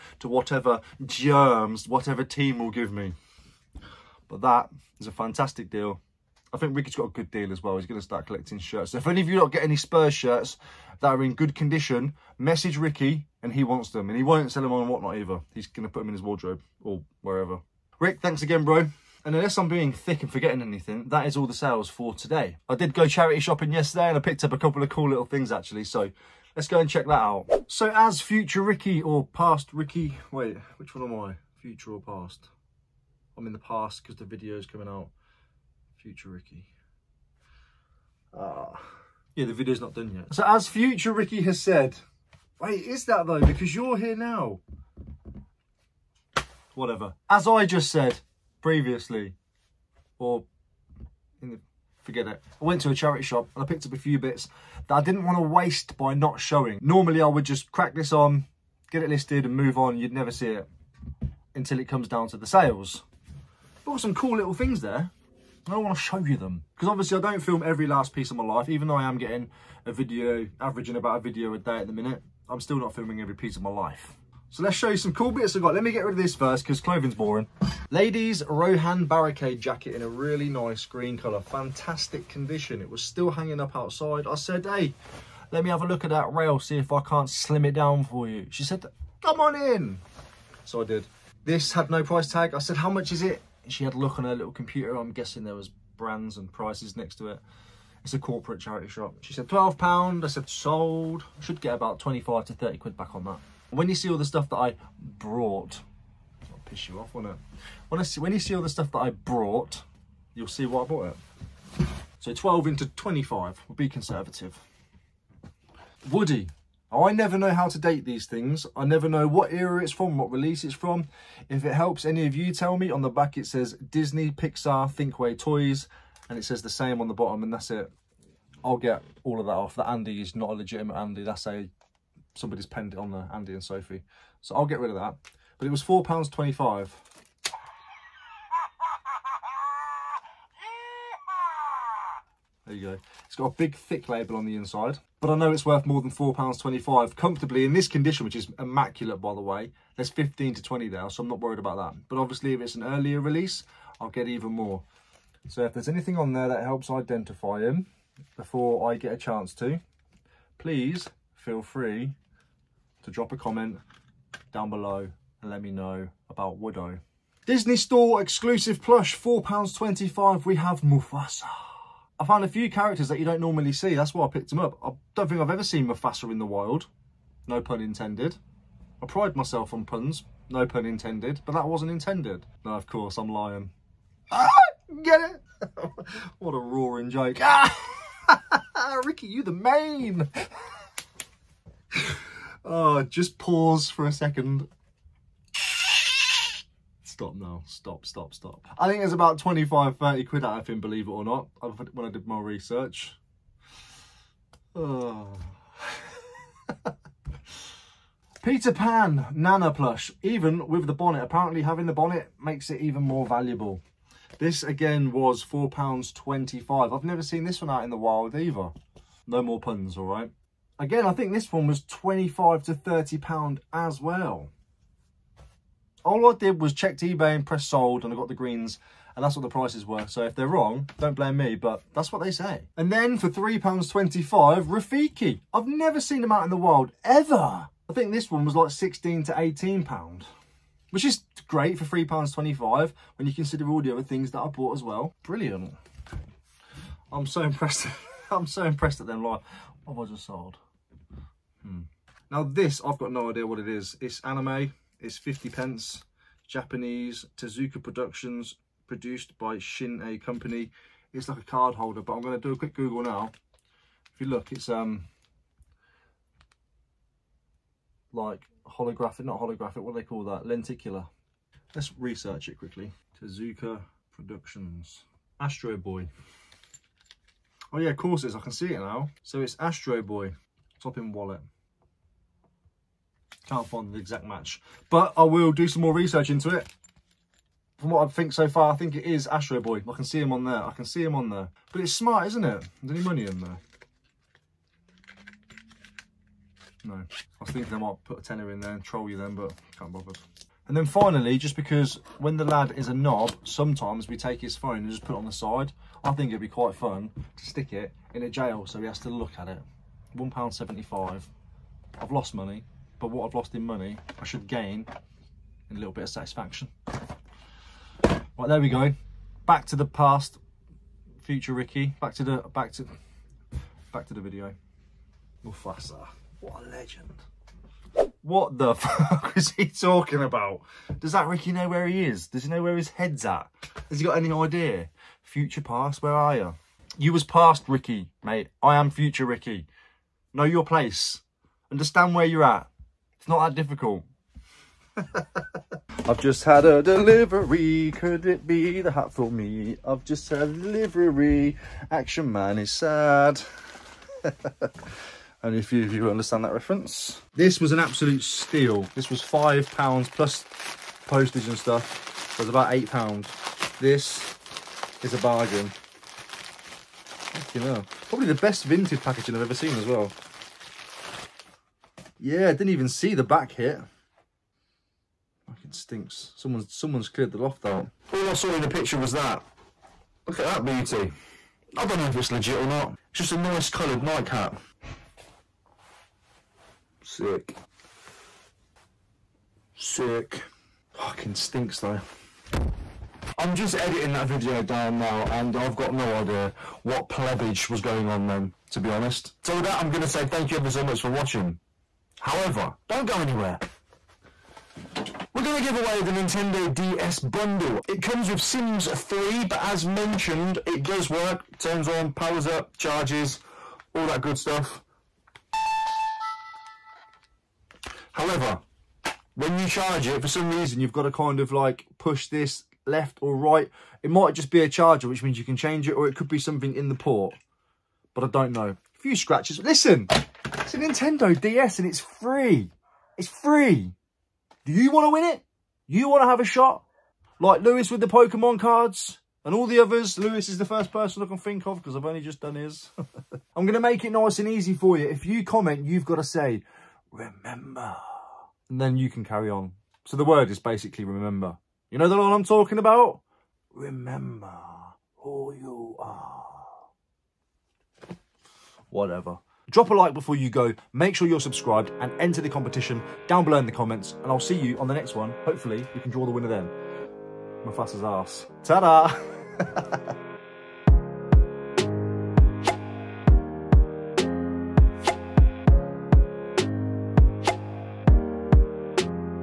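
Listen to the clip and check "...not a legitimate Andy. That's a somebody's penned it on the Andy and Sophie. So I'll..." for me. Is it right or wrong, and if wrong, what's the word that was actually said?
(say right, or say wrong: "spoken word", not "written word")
right.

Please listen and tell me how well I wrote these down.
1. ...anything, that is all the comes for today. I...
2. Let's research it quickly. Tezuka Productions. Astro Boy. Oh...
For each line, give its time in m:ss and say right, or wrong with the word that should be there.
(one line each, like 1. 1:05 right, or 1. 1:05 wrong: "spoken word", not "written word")
1. 0:20 wrong: "sales", not "comes"
2. 4:31 right.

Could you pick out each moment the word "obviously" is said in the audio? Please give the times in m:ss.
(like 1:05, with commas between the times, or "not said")
1:06, 2:32.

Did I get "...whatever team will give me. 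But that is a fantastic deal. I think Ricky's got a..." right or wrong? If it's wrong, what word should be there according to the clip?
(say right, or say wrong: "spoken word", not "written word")
right.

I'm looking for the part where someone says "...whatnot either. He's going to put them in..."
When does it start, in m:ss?
0:14.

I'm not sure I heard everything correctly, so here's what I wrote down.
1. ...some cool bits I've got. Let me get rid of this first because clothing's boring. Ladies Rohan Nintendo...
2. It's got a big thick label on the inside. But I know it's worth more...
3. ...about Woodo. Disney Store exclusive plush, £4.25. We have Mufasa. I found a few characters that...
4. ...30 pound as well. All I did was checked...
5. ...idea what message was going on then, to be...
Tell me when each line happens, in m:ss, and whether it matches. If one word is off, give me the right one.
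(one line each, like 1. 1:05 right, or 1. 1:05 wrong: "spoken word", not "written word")
1. 1:14 wrong: "Barricade", not "Nintendo"
2. 2:23 right
3. 2:46 right
4. 3:42 right
5. 6:36 wrong: "plebage", not "message".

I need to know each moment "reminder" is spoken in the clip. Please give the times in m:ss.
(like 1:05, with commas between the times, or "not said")
not said.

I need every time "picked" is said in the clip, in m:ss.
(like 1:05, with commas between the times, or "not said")
0:24, 0:53, 2:54.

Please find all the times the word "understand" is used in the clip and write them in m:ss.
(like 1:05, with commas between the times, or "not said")
5:41, 5:56.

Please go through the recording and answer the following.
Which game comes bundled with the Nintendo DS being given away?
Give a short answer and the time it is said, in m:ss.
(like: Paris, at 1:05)
Sims 3, at 6:48.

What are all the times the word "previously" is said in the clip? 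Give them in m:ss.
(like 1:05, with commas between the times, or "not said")
0:48.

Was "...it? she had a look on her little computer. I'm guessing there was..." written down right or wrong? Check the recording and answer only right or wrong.
right.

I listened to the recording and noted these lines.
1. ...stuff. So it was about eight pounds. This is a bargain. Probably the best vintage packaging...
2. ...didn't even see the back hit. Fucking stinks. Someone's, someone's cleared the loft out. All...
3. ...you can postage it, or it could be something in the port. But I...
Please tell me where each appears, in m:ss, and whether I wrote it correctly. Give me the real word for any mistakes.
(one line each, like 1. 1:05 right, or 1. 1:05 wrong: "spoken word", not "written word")
1. 6:01 right
2. 6:12 right
3. 7:05 wrong: "change", not "postage".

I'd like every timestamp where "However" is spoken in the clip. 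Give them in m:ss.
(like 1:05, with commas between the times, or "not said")
6:42, 6:58.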